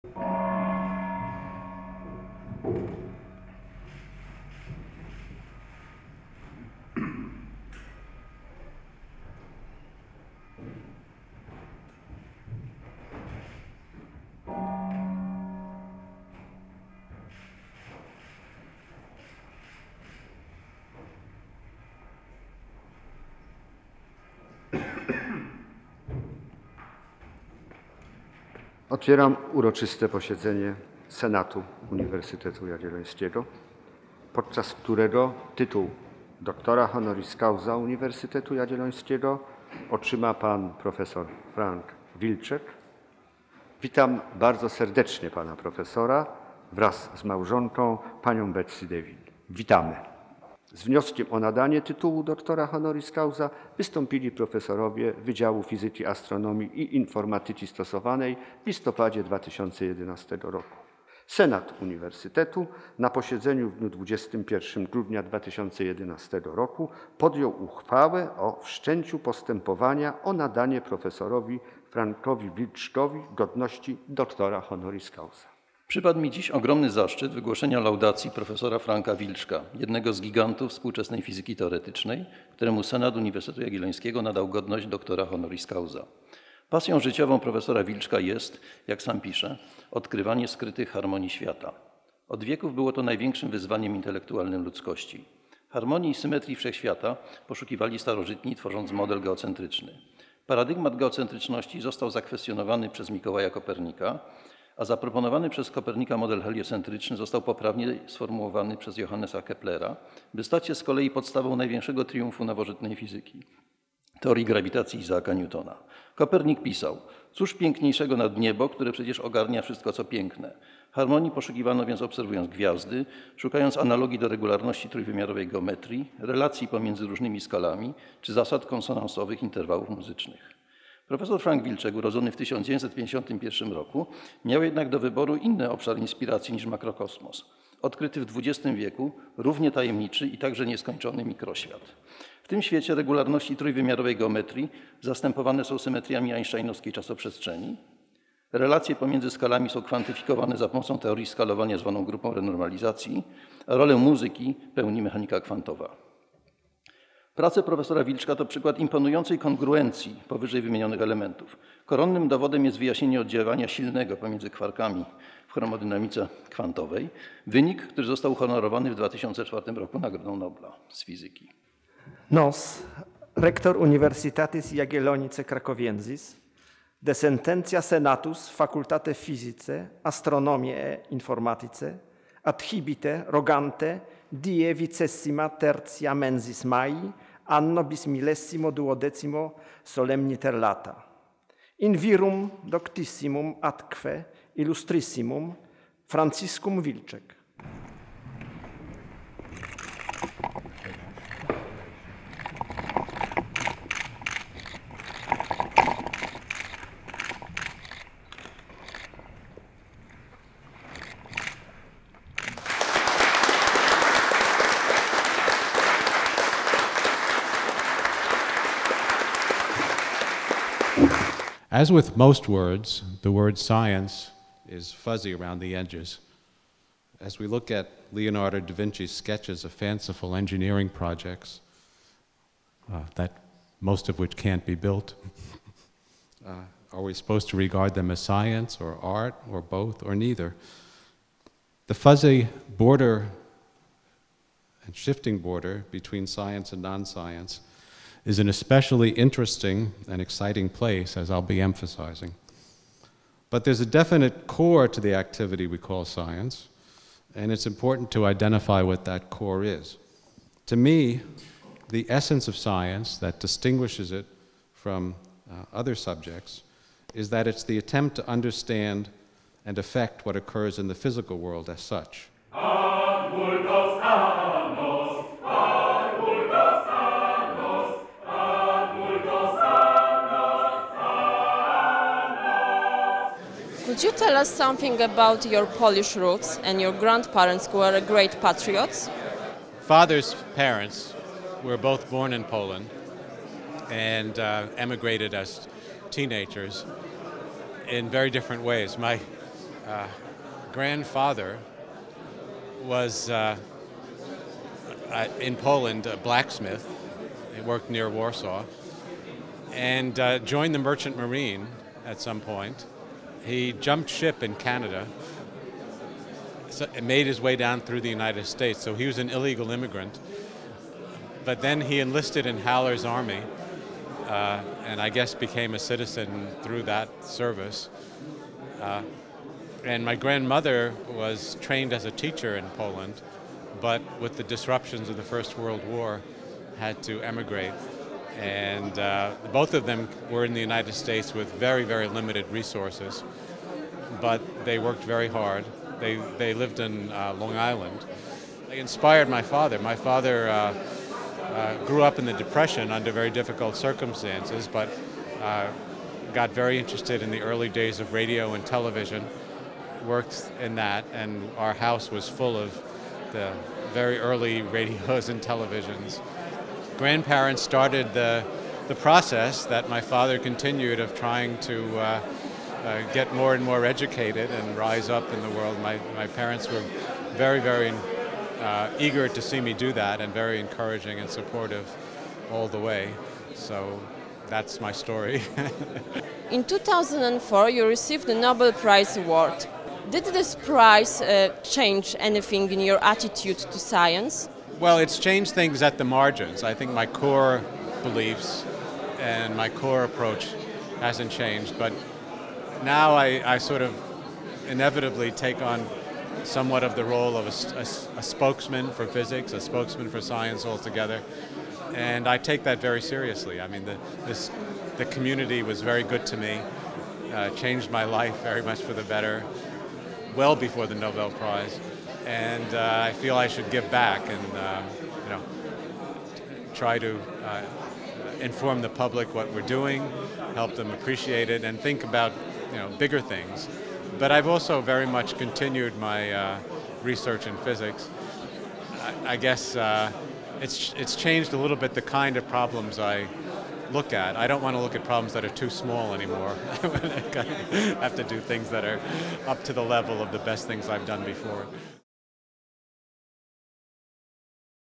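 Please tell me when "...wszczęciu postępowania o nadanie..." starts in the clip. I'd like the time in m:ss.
1:08.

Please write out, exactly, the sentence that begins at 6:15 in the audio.
My, my parents were very, very uh, eager to see me do that and very encouraging and supportive all the way.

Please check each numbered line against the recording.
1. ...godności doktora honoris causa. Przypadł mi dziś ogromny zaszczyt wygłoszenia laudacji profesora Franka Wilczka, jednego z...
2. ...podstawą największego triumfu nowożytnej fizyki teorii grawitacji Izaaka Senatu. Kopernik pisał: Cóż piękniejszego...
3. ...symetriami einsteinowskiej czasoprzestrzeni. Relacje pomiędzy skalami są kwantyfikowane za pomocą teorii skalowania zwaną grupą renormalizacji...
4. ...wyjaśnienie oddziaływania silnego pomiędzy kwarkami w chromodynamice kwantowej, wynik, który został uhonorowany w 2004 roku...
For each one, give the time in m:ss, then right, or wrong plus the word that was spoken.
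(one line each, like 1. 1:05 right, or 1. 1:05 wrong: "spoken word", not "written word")
1. 1:13 right
2. 1:51 wrong: "Newtona", not "Senatu"
3. 2:25 right
4. 2:42 right.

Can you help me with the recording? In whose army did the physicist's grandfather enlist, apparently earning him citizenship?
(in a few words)
Haller's army.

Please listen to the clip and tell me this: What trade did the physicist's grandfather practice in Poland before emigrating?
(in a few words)
Blacksmith.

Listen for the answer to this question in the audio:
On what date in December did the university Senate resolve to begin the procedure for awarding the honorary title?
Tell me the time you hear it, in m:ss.
1:03.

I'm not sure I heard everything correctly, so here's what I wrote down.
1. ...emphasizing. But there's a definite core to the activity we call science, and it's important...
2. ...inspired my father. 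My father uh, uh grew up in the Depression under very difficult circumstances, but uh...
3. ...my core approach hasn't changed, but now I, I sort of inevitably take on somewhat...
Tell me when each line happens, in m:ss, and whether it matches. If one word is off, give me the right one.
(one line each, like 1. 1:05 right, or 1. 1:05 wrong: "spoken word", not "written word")
1. 4:11 right
2. 5:48 right
3. 6:39 right.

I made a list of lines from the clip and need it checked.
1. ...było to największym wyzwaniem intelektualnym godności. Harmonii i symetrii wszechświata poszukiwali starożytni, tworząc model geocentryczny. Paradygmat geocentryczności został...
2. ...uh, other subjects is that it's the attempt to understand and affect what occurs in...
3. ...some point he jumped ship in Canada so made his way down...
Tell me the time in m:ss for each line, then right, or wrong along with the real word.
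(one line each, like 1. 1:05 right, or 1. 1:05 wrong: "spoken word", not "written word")
1. 1:32 wrong: "ludzkości", not "godności"
2. 4:25 right
3. 5:12 right.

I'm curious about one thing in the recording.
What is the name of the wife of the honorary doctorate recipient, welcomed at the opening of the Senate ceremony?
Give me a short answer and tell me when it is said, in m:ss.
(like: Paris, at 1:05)
Betsy Dewin, at 0:48.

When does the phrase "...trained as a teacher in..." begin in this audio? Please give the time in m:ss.
5:31.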